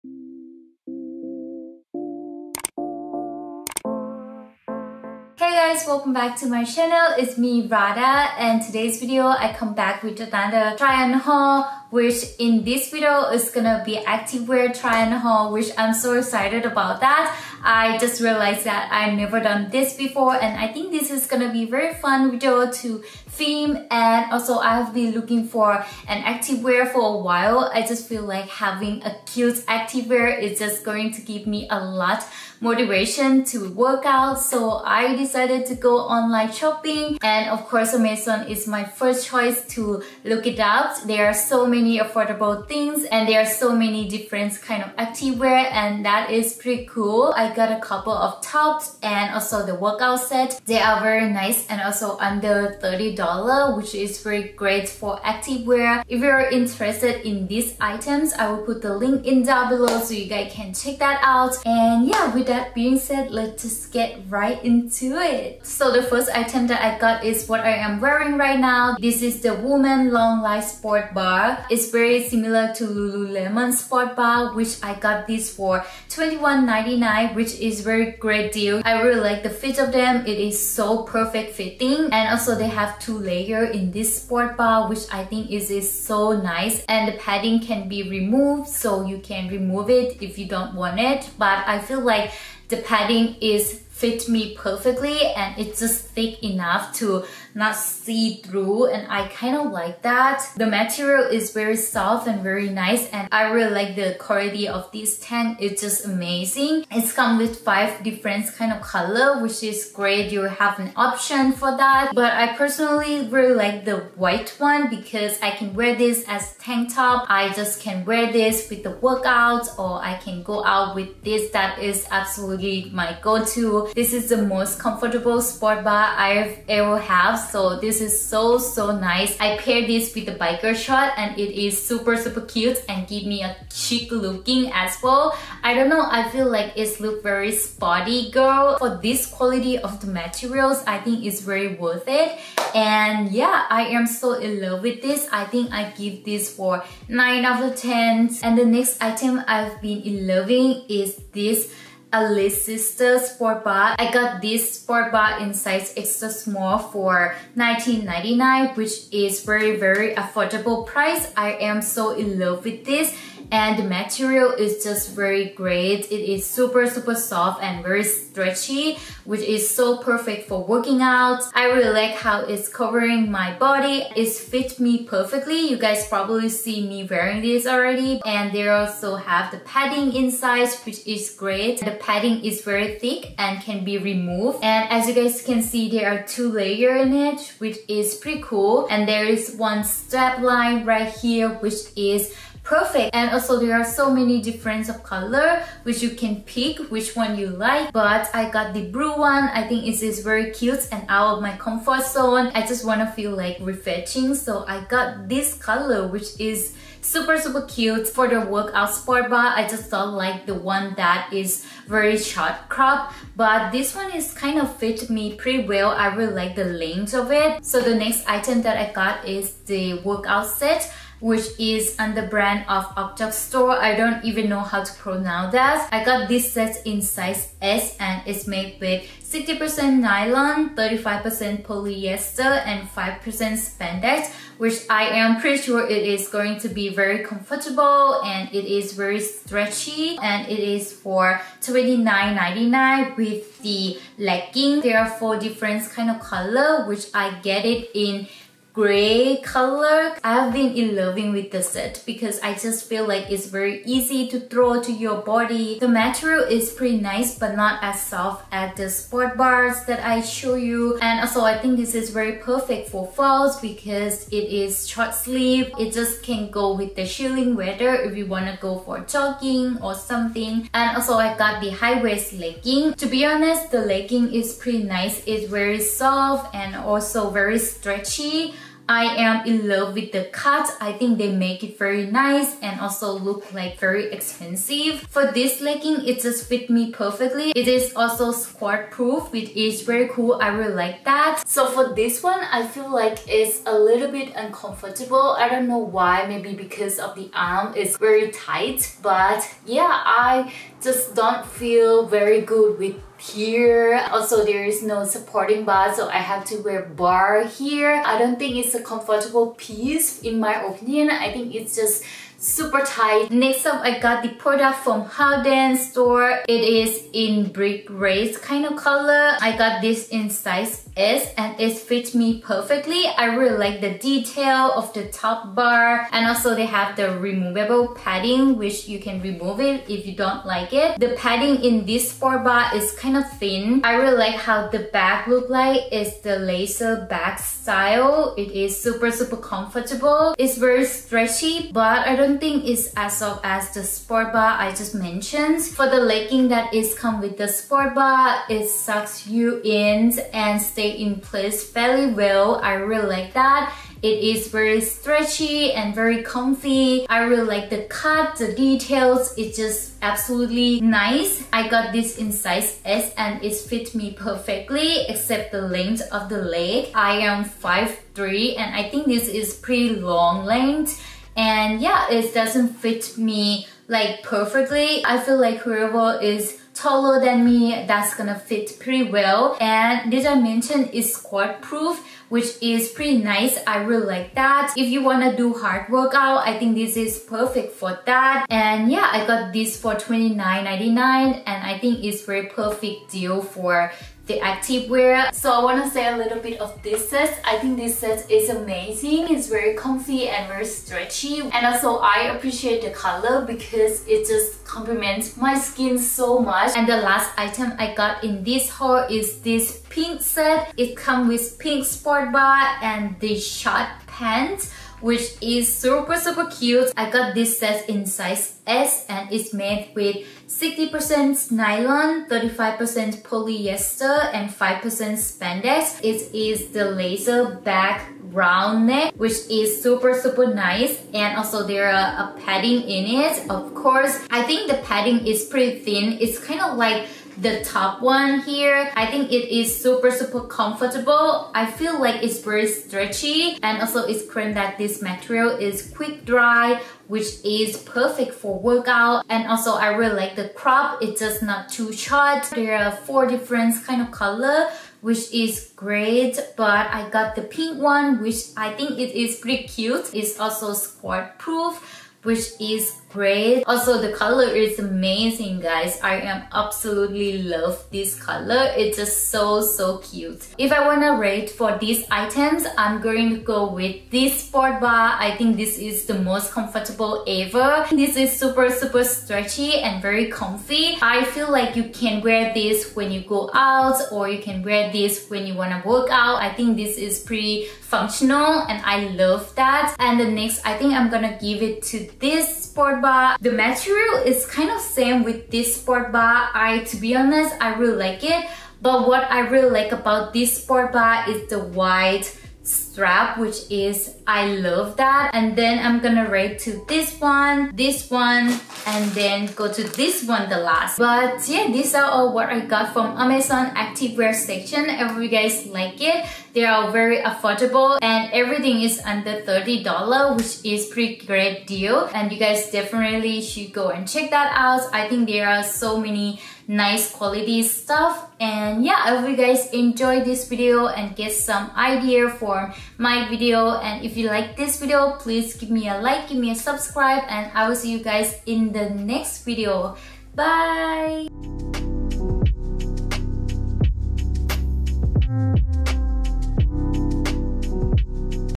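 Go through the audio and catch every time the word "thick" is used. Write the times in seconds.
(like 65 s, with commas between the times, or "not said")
96 s, 182 s.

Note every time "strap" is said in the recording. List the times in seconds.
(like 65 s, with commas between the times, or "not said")
189 s, 502 s.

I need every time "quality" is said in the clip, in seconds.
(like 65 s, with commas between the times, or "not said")
104 s, 139 s, 527 s.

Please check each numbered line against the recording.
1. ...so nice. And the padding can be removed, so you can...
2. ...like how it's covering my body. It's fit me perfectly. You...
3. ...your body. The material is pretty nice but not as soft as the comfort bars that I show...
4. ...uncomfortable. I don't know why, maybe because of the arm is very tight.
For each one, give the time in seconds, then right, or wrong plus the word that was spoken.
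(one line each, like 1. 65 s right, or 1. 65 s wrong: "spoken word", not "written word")
1. 85 s right
2. 171 s right
3. 254 s wrong: "sport", not "comfort"
4. 294 s right.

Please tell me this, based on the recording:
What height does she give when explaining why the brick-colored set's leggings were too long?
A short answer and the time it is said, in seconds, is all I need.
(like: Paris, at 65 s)
5'3, at 367 s.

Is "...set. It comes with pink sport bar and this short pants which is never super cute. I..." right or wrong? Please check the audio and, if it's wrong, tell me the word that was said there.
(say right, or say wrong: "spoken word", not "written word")
wrong: "super", not "never".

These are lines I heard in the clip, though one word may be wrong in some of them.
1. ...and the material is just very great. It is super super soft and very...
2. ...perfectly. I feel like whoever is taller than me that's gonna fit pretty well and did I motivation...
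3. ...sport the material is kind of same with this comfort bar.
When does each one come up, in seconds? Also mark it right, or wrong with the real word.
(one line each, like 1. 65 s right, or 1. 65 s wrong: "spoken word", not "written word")
1. 163 s right
2. 374 s wrong: "mention", not "motivation"
3. 492 s wrong: "sport", not "comfort".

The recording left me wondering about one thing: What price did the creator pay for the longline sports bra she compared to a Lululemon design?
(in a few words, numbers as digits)
$21.99.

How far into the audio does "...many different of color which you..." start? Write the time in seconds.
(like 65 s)
194 s.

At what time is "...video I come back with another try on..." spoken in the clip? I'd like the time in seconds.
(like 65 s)
9 s.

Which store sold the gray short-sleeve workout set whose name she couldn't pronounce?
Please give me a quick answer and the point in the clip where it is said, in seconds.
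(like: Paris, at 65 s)
Upchuck, at 222 s.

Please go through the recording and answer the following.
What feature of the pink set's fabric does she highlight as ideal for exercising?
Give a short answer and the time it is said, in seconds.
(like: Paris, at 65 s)
quick dry, at 445 s.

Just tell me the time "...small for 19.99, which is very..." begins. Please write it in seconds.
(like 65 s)
156 s.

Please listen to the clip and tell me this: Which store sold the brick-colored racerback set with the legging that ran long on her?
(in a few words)
Haodian.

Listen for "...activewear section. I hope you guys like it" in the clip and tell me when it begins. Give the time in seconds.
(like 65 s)
513 s.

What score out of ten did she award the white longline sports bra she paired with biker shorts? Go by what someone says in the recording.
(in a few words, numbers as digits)
9.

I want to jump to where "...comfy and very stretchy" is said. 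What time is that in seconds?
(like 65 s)
399 s.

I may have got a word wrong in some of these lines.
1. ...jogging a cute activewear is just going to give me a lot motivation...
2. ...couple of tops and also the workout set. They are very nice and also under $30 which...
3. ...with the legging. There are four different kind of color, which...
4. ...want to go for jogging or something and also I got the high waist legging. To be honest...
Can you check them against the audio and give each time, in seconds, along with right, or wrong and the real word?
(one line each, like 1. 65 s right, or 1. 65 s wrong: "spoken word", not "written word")
1. 28 s wrong: "having", not "jogging"
2. 47 s right
3. 243 s right
4. 268 s right.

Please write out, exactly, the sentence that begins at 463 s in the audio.
Also, the color is amazing, guys.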